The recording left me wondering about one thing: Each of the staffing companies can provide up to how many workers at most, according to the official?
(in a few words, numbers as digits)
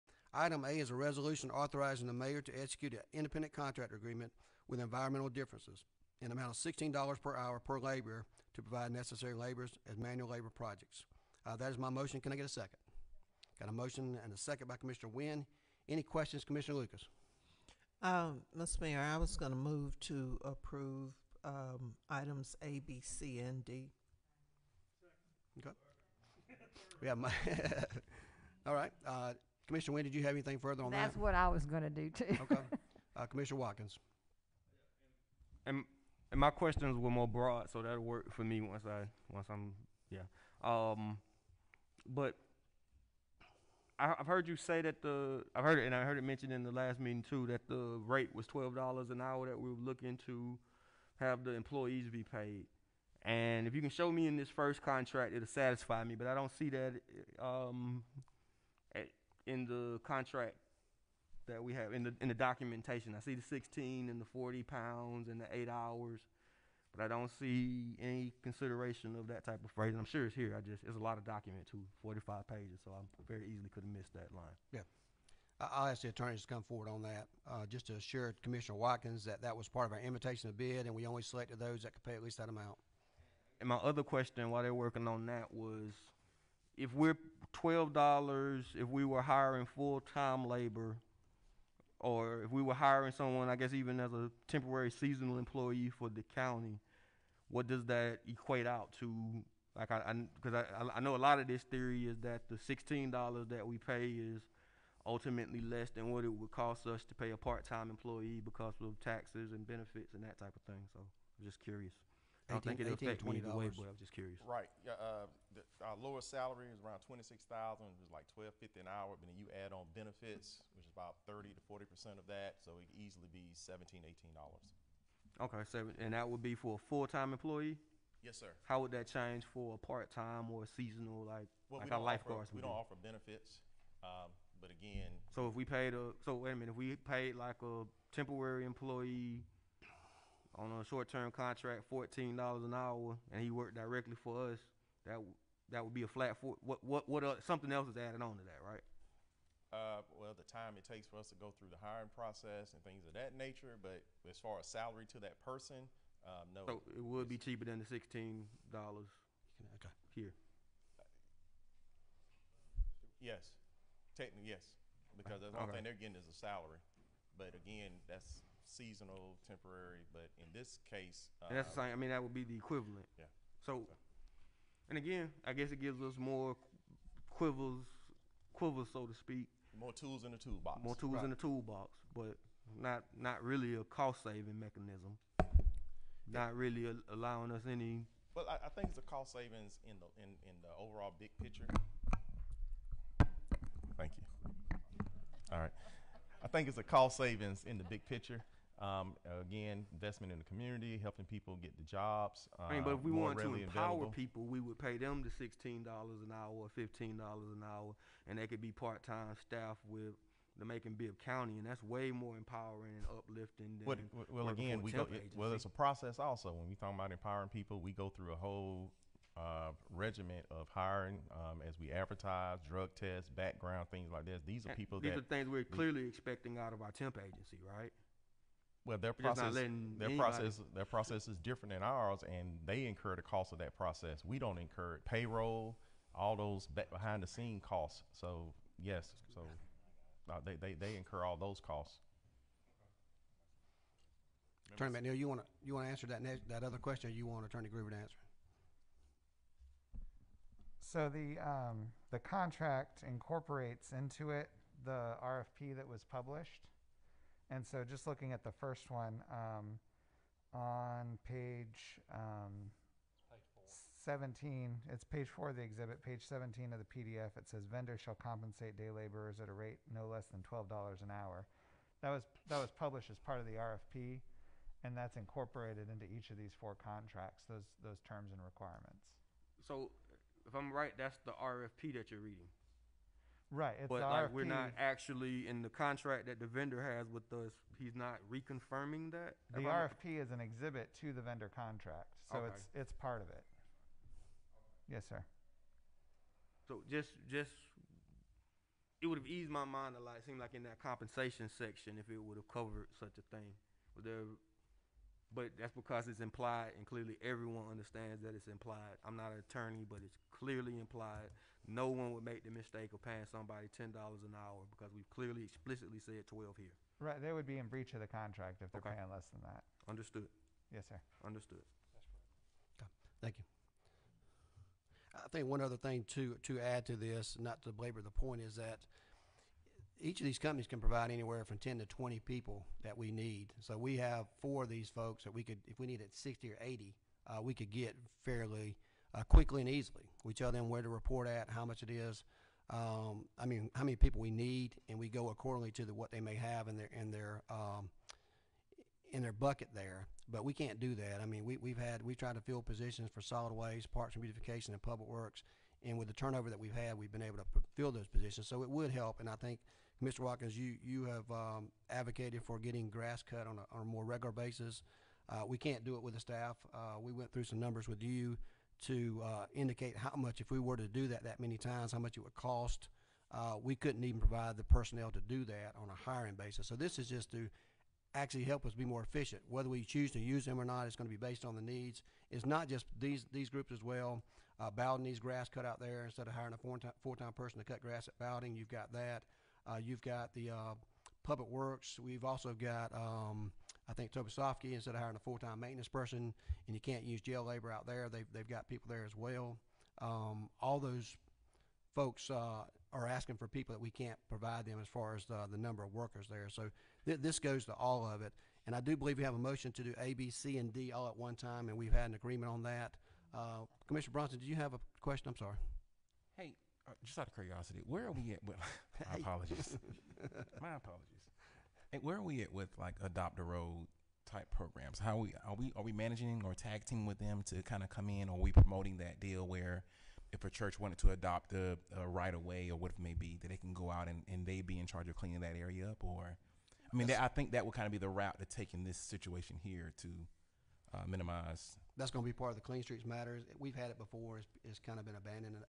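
20.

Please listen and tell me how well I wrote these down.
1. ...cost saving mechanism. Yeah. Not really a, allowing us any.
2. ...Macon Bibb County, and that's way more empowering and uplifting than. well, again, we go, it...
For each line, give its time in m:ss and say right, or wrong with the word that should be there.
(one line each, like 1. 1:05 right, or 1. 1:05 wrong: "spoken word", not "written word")
1. 3:03 right
2. 3:30 right.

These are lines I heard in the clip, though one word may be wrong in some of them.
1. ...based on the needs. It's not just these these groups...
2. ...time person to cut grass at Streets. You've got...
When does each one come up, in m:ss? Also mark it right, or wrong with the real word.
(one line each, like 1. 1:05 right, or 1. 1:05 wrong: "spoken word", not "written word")
1. 6:21 right
2. 6:27 wrong: "Bowden", not "Streets".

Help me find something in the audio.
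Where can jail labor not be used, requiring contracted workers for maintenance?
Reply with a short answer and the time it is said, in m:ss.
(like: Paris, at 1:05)
Tobesofkee, at 6:34.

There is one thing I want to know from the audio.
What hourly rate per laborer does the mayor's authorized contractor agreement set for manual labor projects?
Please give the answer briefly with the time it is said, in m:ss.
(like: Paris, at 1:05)
$16, at 0:06.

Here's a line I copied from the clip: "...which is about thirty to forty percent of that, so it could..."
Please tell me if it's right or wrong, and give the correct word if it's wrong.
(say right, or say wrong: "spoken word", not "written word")
right.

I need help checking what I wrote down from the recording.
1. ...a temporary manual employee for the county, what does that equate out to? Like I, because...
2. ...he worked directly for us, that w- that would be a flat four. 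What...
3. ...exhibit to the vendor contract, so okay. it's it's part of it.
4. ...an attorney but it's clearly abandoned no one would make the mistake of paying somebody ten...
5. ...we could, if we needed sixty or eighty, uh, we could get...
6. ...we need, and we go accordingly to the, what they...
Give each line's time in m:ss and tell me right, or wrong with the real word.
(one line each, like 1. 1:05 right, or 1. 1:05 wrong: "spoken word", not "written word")
1. 1:34 wrong: "seasonal", not "manual"
2. 2:23 right
3. 4:50 right
4. 5:09 wrong: "implied", not "abandoned"
5. 5:35 right
6. 5:44 right.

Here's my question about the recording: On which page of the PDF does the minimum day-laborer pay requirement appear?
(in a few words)
17.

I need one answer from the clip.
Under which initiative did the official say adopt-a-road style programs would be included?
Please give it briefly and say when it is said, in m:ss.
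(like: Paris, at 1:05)
Clean Streets Matters, at 7:22.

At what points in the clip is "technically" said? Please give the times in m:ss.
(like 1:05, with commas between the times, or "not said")
2:44.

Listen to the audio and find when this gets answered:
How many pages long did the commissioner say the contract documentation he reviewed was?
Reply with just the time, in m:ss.
1:12.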